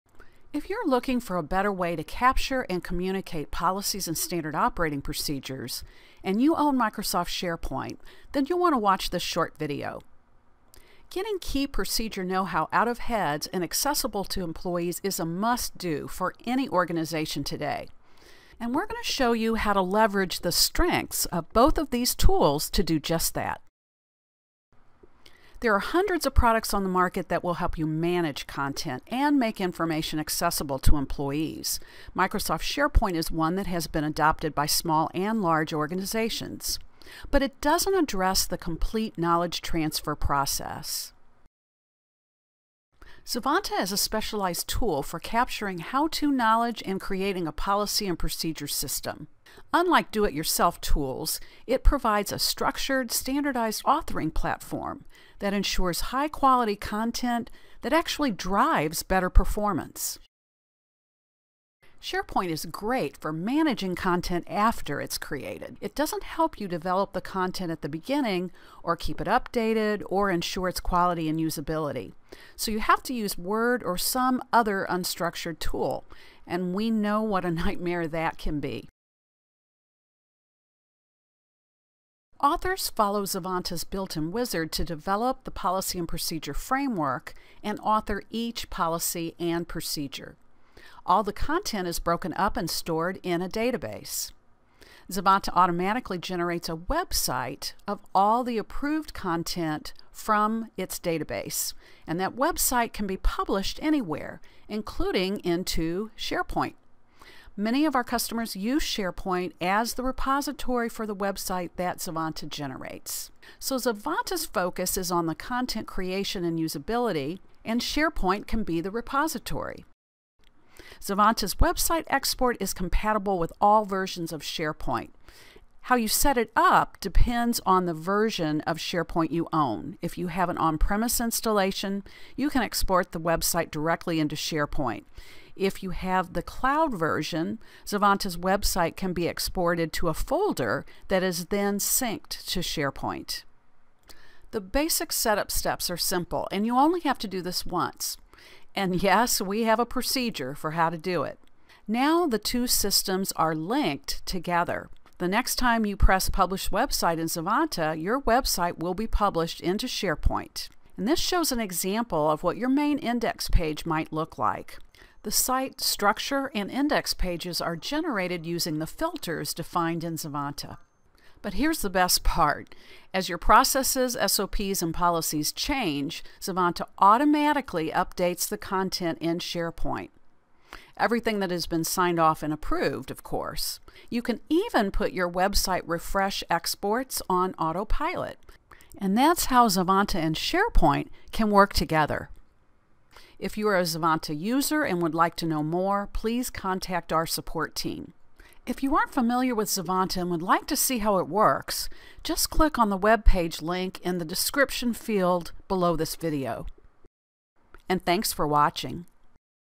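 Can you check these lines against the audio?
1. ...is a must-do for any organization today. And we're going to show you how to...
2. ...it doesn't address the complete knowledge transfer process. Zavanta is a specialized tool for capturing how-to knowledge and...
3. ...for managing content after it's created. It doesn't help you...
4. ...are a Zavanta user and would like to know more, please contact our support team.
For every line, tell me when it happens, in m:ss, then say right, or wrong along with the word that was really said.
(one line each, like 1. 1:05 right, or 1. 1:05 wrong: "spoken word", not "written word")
1. 0:15 right
2. 0:37 right
3. 1:03 right
4. 3:13 right.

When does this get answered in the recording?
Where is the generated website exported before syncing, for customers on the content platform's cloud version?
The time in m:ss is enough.
2:20.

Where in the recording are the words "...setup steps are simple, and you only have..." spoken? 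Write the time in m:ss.
2:25.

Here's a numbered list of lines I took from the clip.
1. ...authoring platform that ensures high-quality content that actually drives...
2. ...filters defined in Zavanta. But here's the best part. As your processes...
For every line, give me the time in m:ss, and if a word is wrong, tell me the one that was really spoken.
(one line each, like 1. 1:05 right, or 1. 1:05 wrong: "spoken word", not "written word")
1. 0:53 right
2. 2:48 right.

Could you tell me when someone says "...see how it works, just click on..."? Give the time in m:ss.
3:20.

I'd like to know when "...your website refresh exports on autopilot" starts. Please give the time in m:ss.
3:05.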